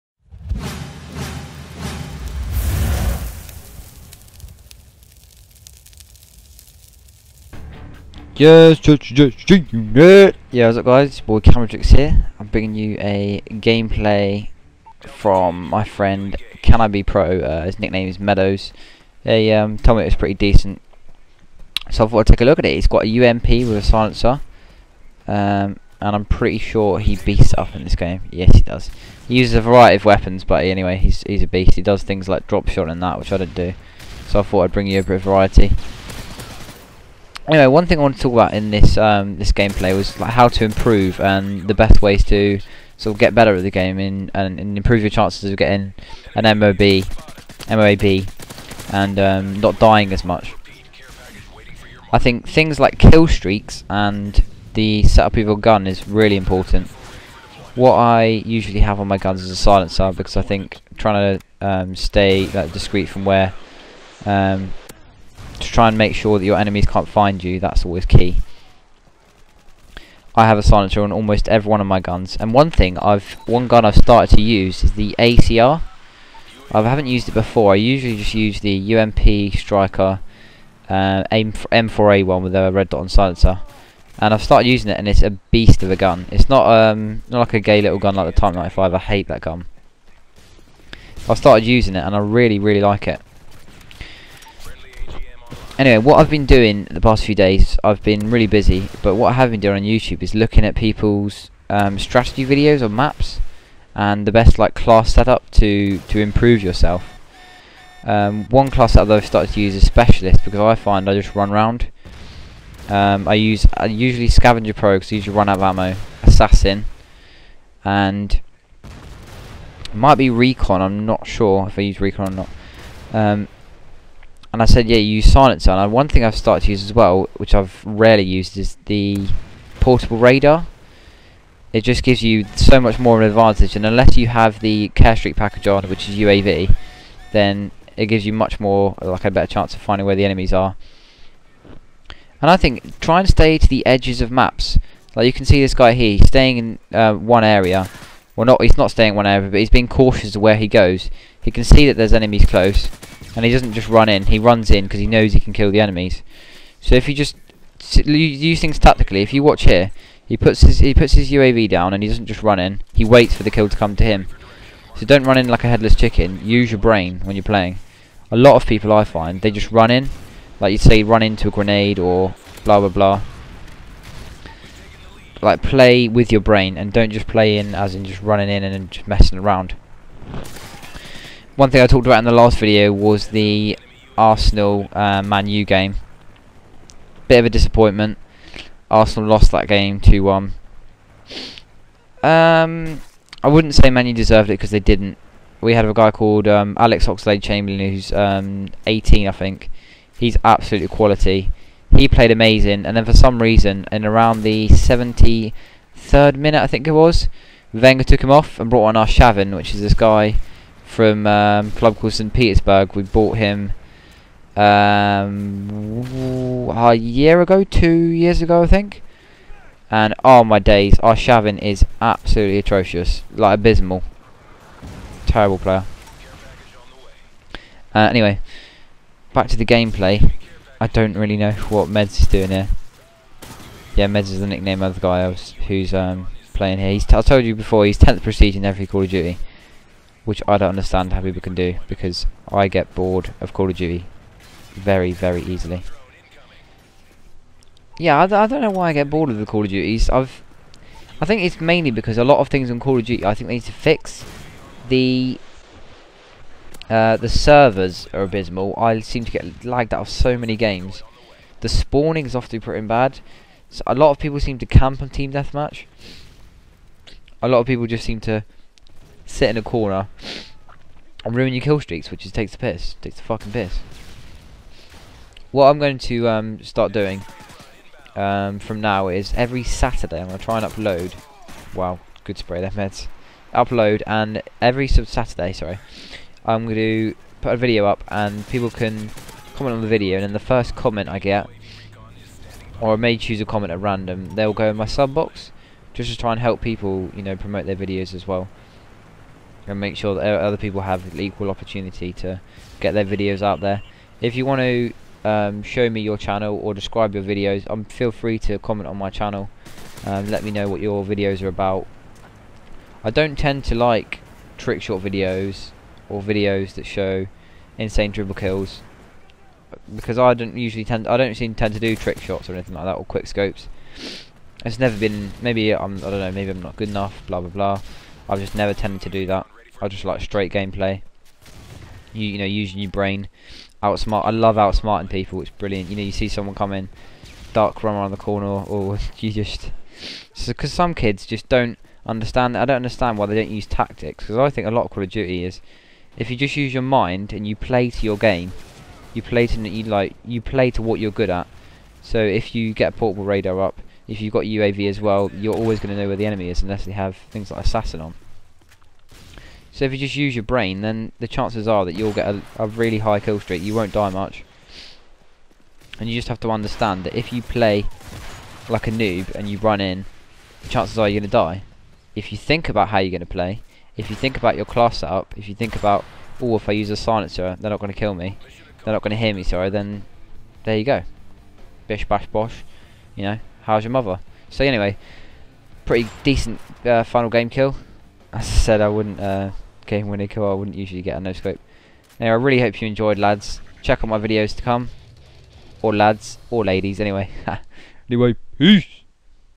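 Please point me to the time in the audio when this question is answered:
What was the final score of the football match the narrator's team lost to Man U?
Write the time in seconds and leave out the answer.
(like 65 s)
189 s.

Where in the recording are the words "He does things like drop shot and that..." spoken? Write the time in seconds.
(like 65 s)
31 s.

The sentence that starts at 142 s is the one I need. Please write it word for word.
And I think try and stay to the edges of maps.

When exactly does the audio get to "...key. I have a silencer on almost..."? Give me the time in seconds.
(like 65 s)
68 s.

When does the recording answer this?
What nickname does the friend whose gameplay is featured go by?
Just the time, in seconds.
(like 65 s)
18 s.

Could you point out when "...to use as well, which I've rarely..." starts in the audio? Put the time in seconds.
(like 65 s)
126 s.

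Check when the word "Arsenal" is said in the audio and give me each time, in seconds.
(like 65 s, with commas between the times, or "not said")
184 s, 188 s.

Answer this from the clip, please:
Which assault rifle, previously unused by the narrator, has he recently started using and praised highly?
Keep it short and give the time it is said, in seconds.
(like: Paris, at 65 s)
ACR, at 75 s.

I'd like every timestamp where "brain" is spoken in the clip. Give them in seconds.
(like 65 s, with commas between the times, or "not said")
166 s, 176 s, 332 s, 360 s.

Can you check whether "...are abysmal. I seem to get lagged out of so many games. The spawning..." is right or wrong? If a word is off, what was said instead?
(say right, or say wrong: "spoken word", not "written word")
right.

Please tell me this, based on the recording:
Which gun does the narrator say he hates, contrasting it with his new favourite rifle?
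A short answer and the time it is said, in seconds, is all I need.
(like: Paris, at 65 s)
Type 95, at 88 s.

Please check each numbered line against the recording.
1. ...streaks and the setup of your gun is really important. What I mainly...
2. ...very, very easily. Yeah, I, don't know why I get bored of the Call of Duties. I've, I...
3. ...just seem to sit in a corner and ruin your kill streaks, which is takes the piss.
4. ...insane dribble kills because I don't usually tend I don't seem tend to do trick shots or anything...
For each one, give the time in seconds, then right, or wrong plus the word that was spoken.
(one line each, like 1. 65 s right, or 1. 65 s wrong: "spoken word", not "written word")
1. 53 s wrong: "usually", not "mainly"
2. 244 s right
3. 267 s right
4. 317 s right.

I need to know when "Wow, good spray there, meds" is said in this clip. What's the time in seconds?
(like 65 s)
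281 s.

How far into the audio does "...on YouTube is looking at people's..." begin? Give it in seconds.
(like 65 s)
99 s.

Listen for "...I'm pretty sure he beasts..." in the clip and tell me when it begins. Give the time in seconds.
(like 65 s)
26 s.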